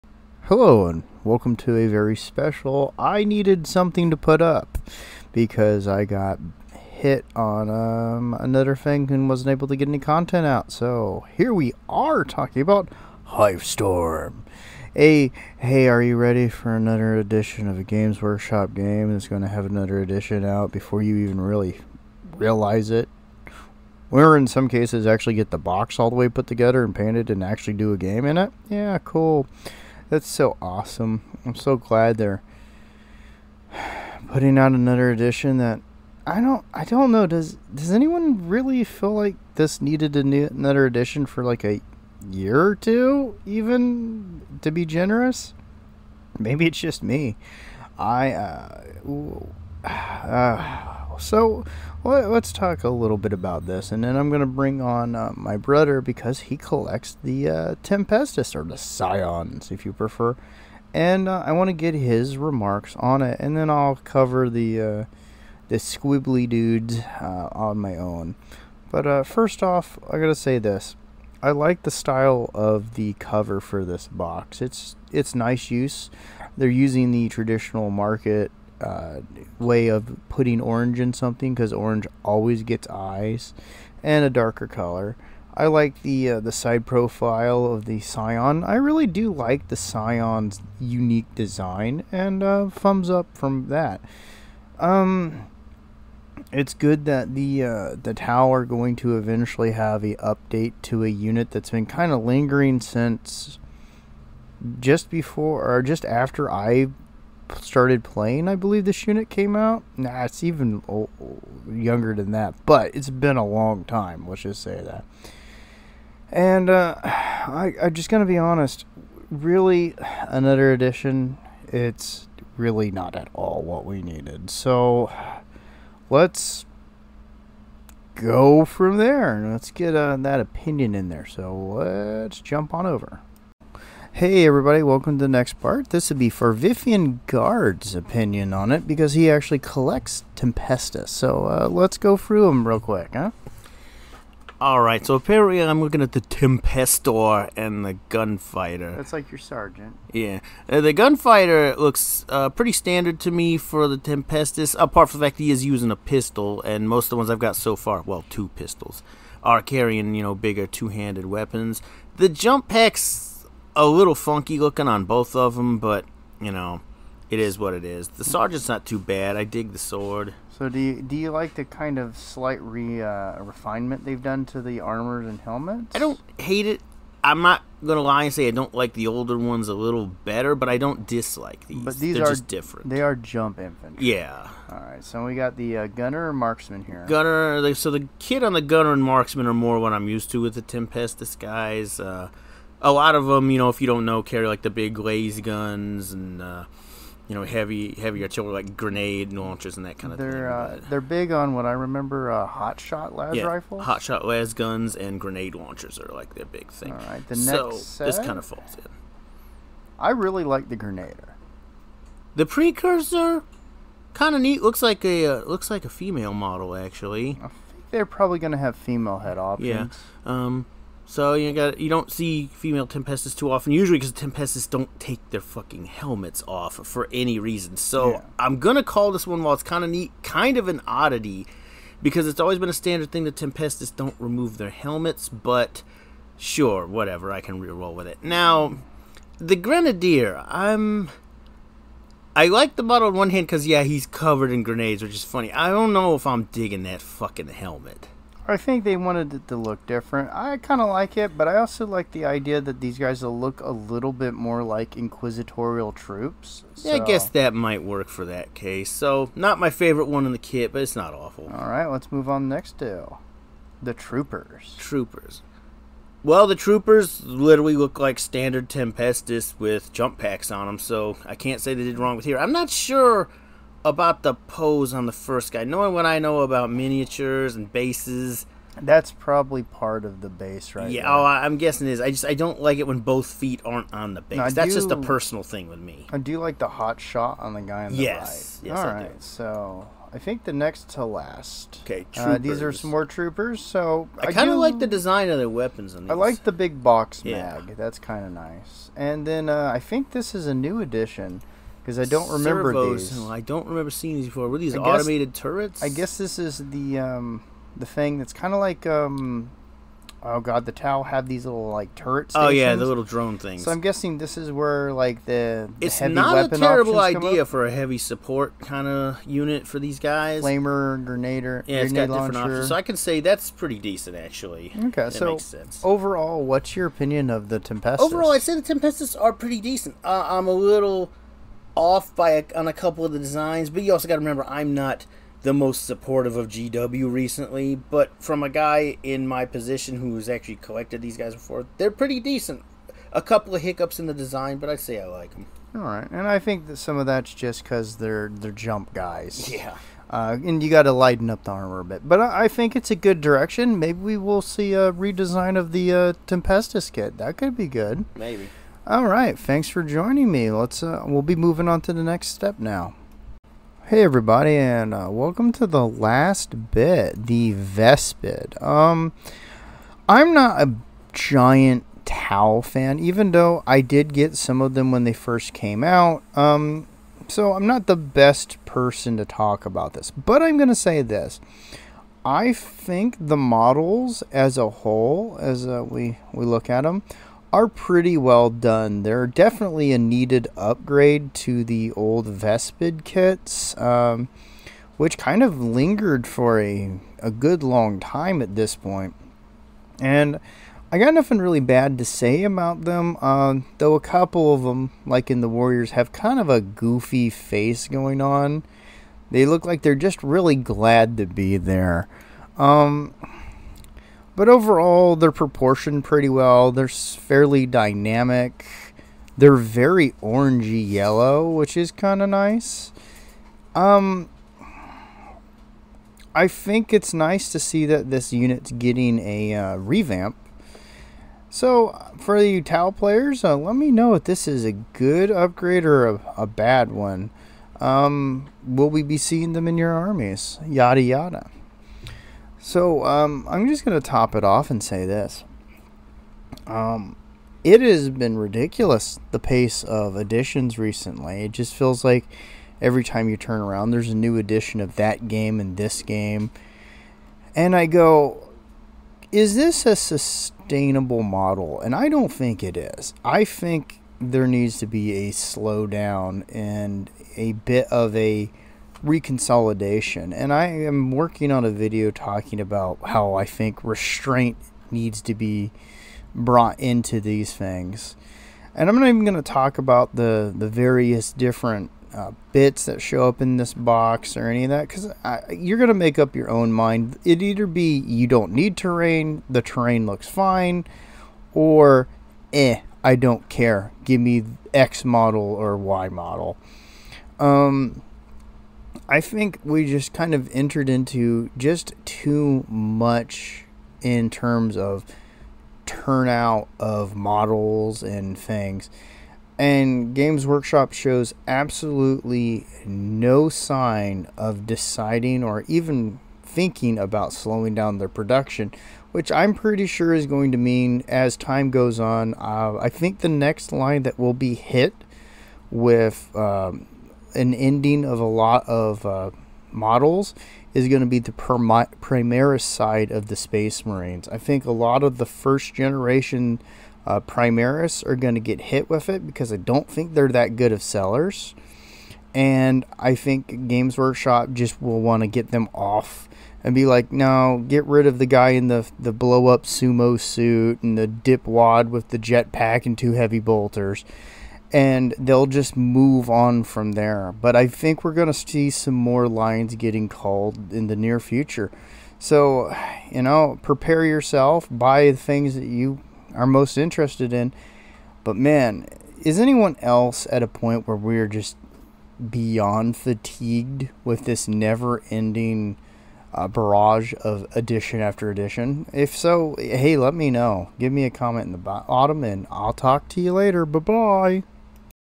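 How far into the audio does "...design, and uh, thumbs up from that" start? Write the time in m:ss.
1:31.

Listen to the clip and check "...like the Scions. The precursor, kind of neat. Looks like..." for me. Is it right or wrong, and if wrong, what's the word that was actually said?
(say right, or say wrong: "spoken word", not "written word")
wrong: "Grenadier", not "Scions".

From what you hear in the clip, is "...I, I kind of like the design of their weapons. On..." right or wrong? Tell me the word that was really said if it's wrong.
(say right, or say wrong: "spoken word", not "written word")
right.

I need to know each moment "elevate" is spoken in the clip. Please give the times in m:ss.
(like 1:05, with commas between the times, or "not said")
not said.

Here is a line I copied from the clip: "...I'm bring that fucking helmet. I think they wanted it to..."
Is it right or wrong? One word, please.
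wrong.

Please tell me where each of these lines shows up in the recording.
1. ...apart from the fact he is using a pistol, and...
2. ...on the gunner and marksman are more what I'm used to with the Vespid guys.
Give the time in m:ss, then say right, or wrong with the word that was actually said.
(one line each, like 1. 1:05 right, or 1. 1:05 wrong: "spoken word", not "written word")
1. 2:34 right
2. 3:08 wrong: "Tempestus", not "Vespid".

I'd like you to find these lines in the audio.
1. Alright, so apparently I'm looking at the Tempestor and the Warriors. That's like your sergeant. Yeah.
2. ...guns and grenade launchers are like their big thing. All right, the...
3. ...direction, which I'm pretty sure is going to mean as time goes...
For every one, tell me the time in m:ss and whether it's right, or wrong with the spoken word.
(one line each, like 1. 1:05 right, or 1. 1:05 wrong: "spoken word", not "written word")
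1. 2:24 wrong: "Gunfighter", not "Warriors"
2. 3:24 right
3. 8:38 wrong: "production", not "direction".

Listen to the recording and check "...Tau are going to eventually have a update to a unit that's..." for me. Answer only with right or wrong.
right.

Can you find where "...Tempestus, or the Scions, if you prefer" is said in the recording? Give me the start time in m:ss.
0:57.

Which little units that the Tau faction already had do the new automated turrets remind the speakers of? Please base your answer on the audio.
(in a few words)
Drone things.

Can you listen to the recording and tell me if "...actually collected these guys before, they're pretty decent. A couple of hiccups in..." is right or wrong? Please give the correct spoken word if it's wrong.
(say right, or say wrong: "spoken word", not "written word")
right.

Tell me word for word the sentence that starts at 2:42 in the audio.
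The jump packs a little funky looking on both of them, but you know, it is what it is.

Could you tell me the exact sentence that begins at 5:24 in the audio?
Okay, that so overall, what's your opinion of the Tempestus?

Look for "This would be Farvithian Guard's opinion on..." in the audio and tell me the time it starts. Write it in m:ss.
2:15.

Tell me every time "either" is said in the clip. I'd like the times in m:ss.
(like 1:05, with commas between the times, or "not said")
8:07.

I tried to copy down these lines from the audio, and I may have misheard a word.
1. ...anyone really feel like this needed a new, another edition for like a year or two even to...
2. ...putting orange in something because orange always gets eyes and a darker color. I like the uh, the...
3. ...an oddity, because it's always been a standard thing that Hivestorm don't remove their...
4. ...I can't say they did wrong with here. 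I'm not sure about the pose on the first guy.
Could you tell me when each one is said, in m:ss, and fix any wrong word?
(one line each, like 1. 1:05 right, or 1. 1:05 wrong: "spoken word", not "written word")
1. 0:37 right
2. 1:20 right
3. 3:50 wrong: "Tempestus", not "Hivestorm"
4. 4:31 right.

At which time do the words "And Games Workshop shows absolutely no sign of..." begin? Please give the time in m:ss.
8:29.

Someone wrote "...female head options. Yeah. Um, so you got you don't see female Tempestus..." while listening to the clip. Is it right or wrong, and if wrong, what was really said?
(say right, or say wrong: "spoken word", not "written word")
right.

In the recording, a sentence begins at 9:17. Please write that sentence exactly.
But I think we're going to see some more lines getting called in the near future.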